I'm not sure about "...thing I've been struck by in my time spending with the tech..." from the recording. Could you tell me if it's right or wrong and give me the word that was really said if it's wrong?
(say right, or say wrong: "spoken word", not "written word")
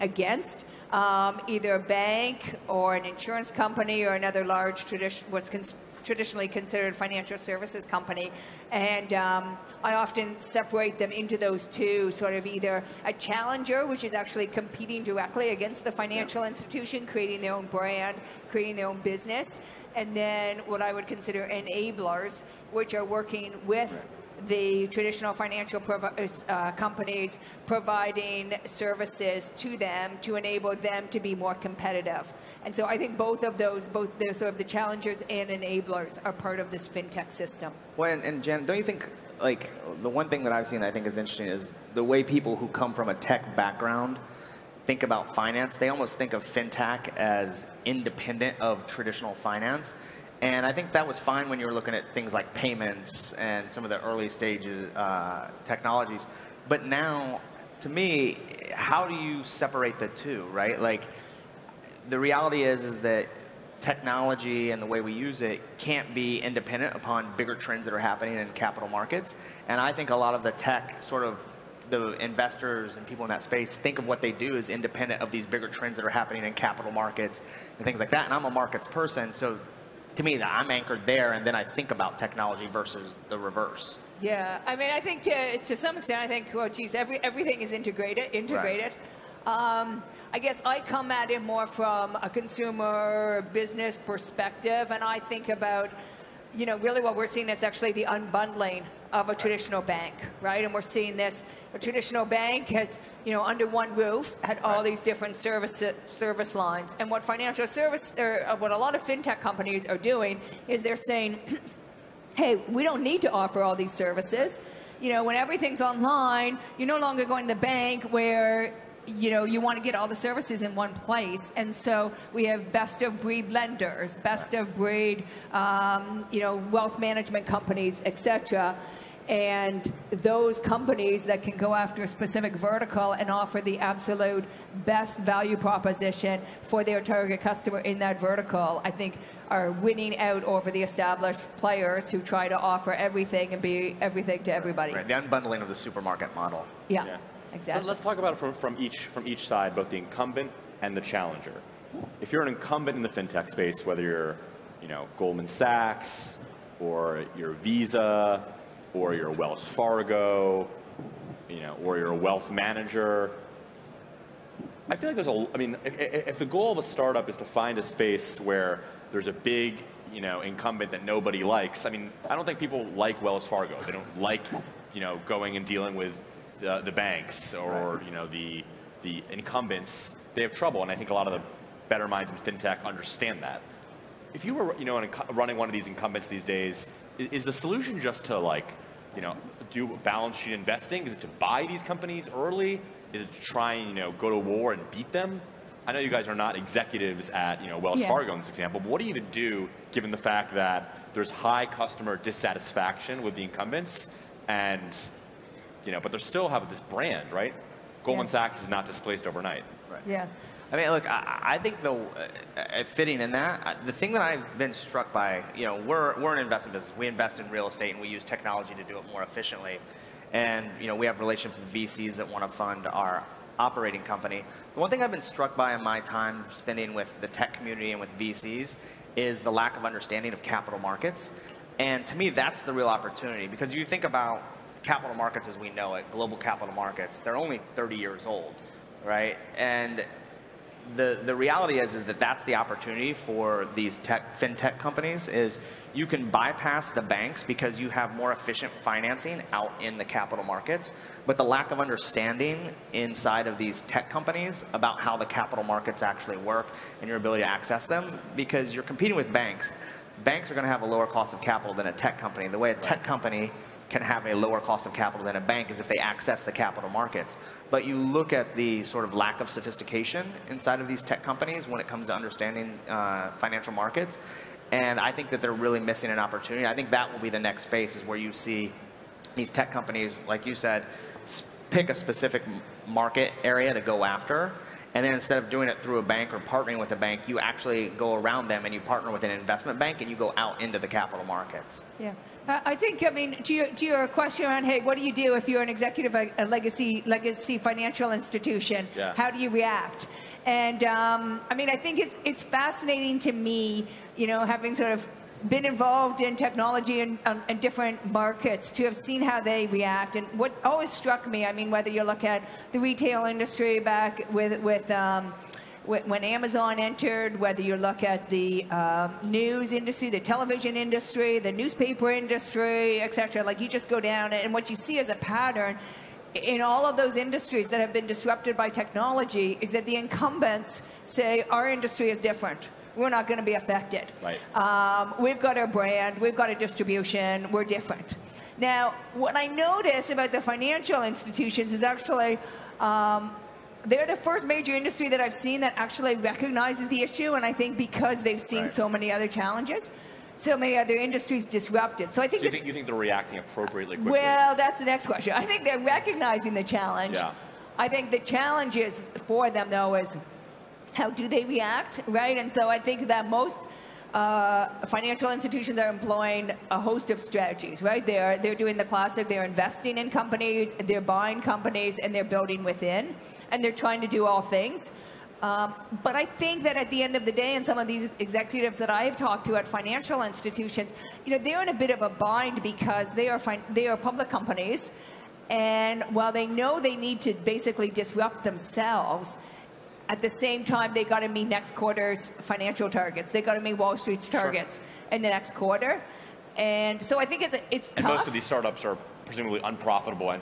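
right.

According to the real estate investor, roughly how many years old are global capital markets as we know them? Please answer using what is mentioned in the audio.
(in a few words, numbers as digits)
30.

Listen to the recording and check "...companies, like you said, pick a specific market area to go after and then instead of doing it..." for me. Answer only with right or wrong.
right.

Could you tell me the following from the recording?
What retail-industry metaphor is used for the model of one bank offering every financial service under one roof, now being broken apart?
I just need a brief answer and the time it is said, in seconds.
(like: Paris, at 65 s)
the supermarket model, at 145 s.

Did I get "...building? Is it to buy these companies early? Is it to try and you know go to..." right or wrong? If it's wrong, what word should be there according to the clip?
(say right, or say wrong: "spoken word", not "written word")
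wrong: "investing", not "building".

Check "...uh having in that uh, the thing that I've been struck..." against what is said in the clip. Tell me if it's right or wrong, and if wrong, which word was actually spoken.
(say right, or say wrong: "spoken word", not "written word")
wrong: "fitting", not "having".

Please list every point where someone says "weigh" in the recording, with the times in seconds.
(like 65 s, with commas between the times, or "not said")
not said.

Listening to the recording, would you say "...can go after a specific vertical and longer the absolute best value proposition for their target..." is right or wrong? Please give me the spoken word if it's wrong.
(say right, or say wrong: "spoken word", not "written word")
wrong: "offer", not "longer".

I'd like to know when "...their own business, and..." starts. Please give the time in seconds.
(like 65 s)
18 s.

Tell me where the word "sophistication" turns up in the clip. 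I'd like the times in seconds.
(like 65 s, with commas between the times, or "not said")
269 s.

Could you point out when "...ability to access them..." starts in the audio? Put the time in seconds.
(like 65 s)
257 s.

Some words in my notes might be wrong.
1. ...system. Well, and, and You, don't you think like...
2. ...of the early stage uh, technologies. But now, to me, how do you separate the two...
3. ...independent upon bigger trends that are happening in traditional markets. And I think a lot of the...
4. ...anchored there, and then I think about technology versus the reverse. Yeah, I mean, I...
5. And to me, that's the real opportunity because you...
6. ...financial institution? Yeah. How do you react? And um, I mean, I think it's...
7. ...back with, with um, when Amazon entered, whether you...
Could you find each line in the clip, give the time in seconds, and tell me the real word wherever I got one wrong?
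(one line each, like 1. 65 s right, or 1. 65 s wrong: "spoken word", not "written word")
1. 37 s wrong: "Jen", not "You"
2. 53 s right
3. 66 s wrong: "capital", not "traditional"
4. 80 s right
5. 231 s right
6. 297 s right
7. 313 s right.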